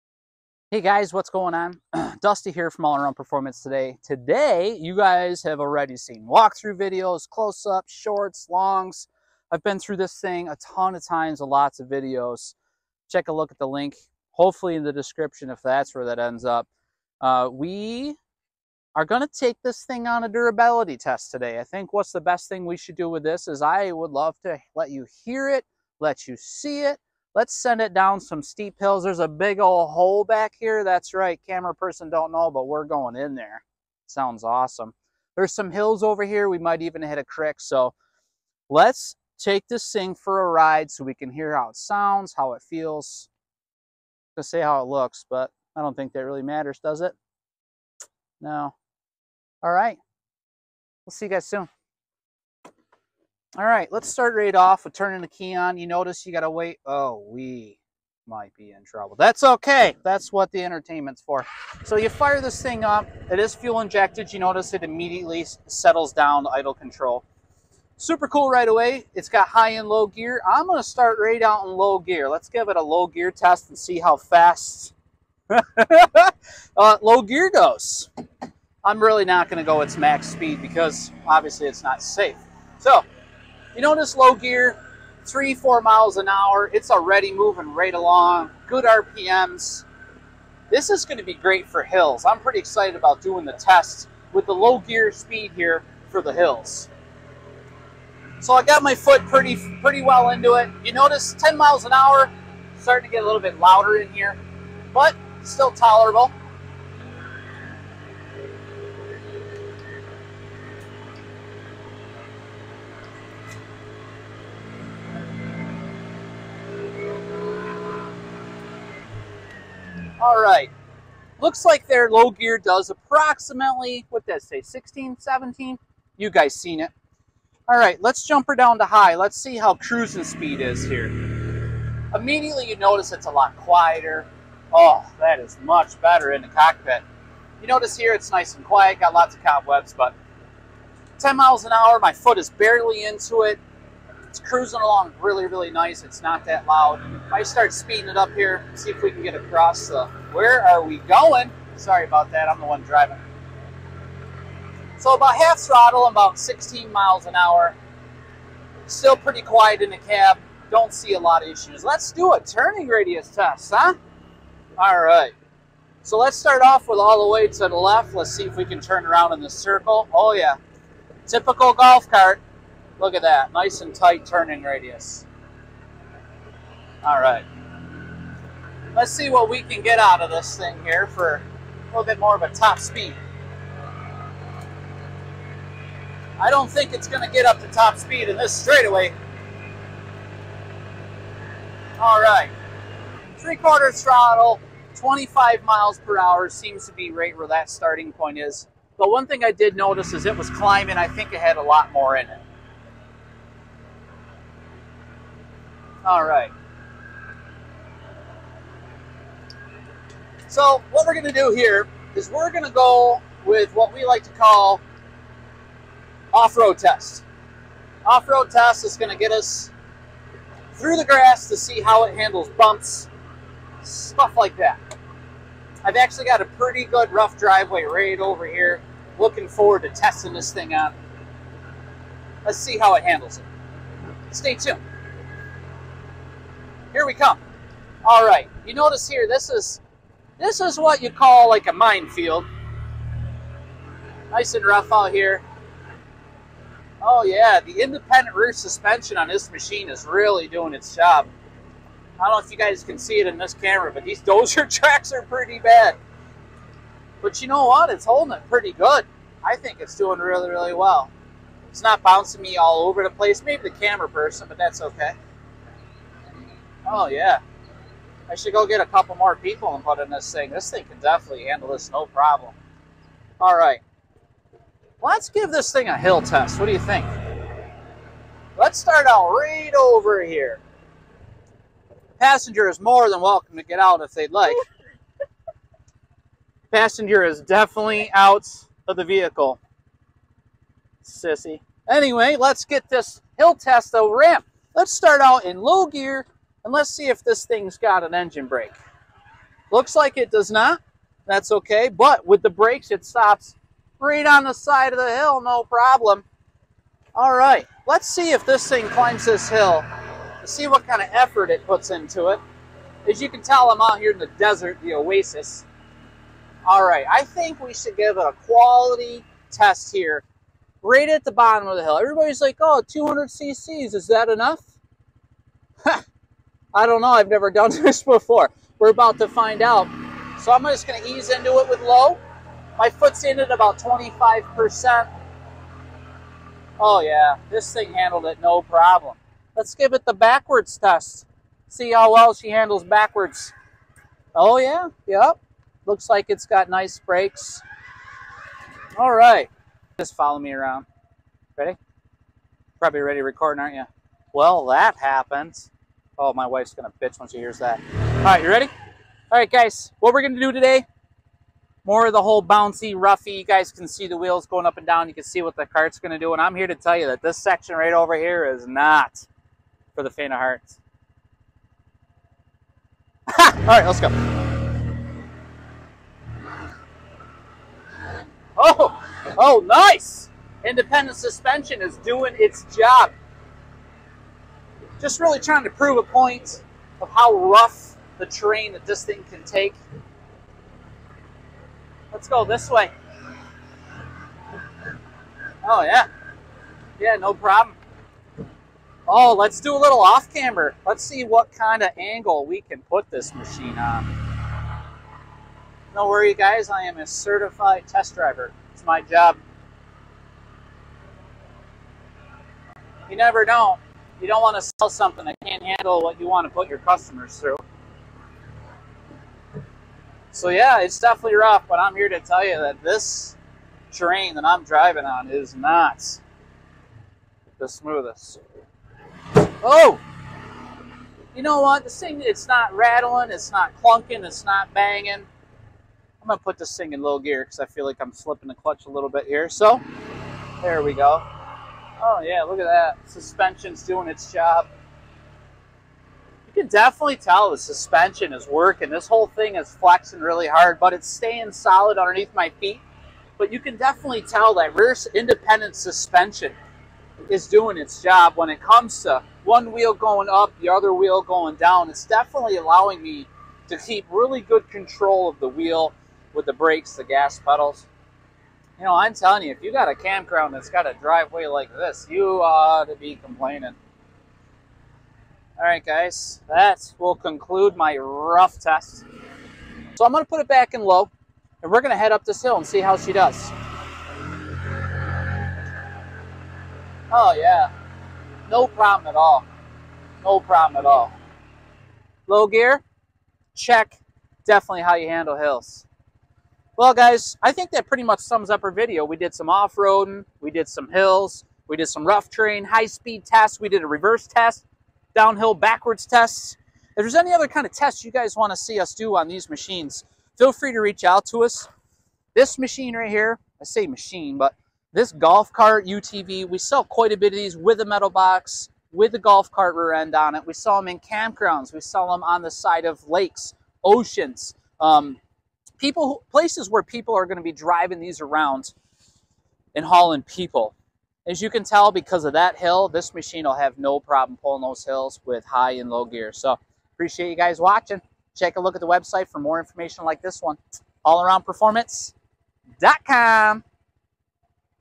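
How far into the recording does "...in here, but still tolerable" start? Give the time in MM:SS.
01:43.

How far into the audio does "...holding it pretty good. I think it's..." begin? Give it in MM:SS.
04:18.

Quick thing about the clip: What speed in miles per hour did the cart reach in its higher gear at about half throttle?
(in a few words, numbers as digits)
16 mph.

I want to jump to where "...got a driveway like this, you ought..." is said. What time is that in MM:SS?
07:50.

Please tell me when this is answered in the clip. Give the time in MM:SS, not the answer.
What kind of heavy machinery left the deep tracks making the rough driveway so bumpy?
04:14.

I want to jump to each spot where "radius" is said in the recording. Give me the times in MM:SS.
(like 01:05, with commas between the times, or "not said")
02:42, 02:54.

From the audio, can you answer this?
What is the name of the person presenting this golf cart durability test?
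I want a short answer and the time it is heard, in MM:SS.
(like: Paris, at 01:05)
Dusty, at 00:02.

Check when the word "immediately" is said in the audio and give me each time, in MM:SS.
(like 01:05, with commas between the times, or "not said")
01:04, 02:12.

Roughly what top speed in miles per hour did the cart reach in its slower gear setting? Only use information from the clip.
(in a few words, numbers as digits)
16-17 mph.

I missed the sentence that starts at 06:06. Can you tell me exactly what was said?
And I'm here to tell you that this section right over here is not for the faint of heart.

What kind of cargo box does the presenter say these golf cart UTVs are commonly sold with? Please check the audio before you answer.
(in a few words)
Metal box.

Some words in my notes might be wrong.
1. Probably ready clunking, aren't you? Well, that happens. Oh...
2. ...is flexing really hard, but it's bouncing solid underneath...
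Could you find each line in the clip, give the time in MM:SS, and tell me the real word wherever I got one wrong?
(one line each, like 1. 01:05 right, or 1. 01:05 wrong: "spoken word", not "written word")
1. 05:52 wrong: "recording", not "clunking"
2. 07:29 wrong: "staying", not "bouncing".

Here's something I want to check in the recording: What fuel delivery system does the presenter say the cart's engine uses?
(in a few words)
Fuel injected.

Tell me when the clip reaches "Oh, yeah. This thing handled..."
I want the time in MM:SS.
05:36.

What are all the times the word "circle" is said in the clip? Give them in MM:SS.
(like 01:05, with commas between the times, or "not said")
02:49.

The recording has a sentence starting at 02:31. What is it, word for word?
Sorry about that, I'm the one driving.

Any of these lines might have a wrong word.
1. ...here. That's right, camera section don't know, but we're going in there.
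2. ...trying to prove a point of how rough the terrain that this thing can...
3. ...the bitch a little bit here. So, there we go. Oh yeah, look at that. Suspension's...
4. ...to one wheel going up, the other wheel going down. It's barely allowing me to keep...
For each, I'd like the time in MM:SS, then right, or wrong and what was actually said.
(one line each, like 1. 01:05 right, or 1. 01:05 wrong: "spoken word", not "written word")
1. 00:30 wrong: "person", not "section"
2. 06:25 right
3. 07:18 wrong: "clutch", not "bitch"
4. 07:39 wrong: "definitely", not "barely".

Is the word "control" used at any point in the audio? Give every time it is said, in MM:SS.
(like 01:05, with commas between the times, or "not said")
01:06, 07:44.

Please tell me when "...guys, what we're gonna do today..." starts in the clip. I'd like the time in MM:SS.
05:59.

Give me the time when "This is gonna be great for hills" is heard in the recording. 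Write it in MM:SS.
01:30.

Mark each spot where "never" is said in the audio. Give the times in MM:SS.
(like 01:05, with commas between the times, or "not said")
05:27, 06:53.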